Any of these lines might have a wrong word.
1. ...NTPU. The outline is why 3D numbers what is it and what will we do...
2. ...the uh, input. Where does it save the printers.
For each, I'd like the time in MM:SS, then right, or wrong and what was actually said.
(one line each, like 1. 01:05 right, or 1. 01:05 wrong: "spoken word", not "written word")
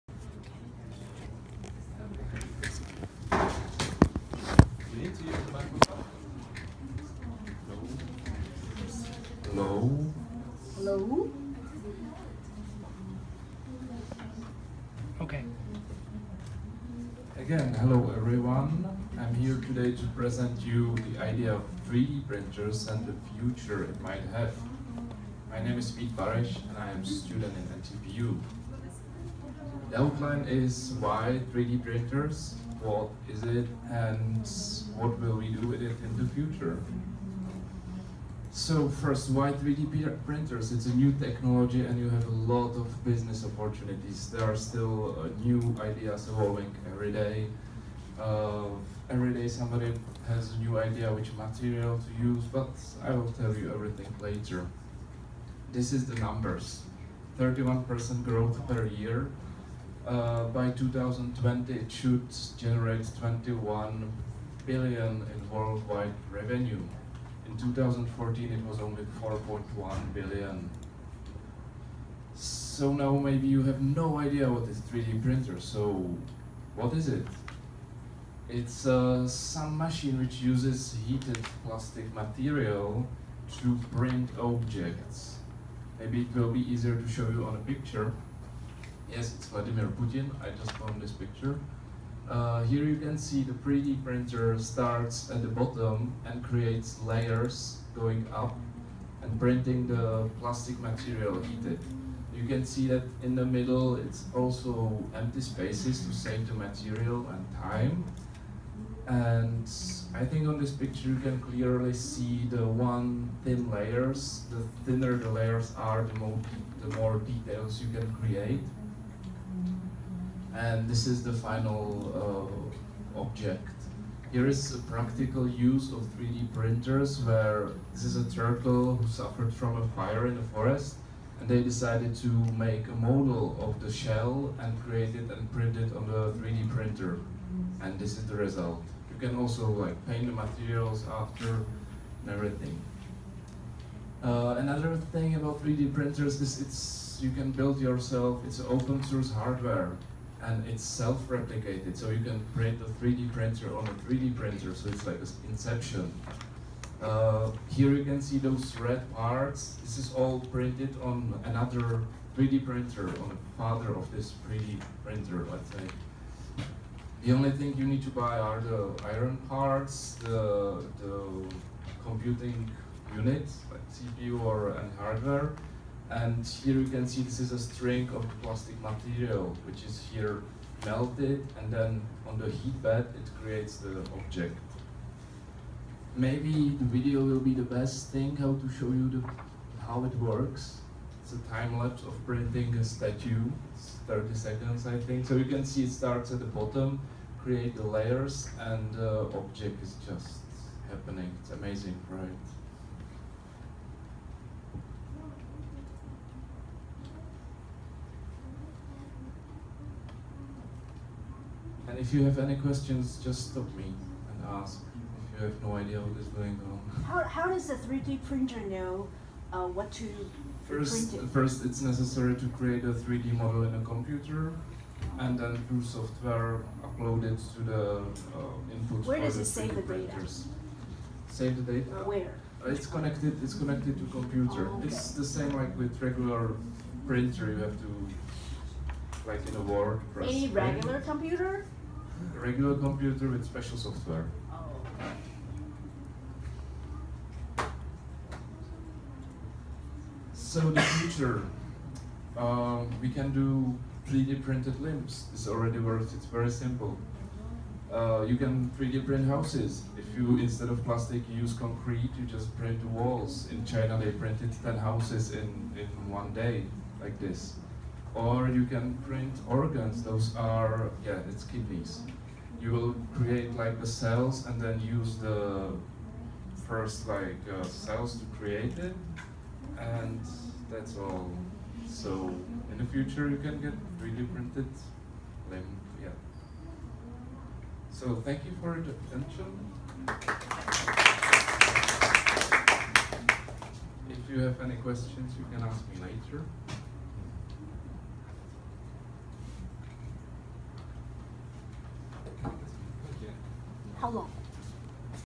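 1. 00:27 wrong: "printers", not "numbers"
2. 03:47 right.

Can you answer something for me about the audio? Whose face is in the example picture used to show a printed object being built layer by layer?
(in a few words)
Vladimir Putin.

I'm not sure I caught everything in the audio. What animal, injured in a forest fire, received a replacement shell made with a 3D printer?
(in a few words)
turtle.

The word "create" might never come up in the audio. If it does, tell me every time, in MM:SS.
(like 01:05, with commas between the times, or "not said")
01:36, 01:58, 02:14, 03:03, 03:17, 03:42, 04:33, 04:38.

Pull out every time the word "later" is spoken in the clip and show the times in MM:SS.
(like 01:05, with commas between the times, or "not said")
00:54, 04:56.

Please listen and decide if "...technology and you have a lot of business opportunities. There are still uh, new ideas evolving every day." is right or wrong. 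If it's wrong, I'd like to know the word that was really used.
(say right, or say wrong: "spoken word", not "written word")
right.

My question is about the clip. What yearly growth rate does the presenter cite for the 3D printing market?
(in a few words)
31%.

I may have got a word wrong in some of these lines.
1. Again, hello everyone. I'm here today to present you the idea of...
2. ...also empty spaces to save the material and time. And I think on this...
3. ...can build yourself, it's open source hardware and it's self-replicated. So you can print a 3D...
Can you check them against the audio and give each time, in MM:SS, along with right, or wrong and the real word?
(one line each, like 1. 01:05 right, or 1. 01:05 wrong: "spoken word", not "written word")
1. 00:17 right
2. 01:44 right
3. 02:27 right.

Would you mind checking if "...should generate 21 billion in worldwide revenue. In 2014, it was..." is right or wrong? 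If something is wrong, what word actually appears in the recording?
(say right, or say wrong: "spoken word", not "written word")
right.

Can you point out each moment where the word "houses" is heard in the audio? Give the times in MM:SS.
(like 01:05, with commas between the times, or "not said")
04:19, 04:24.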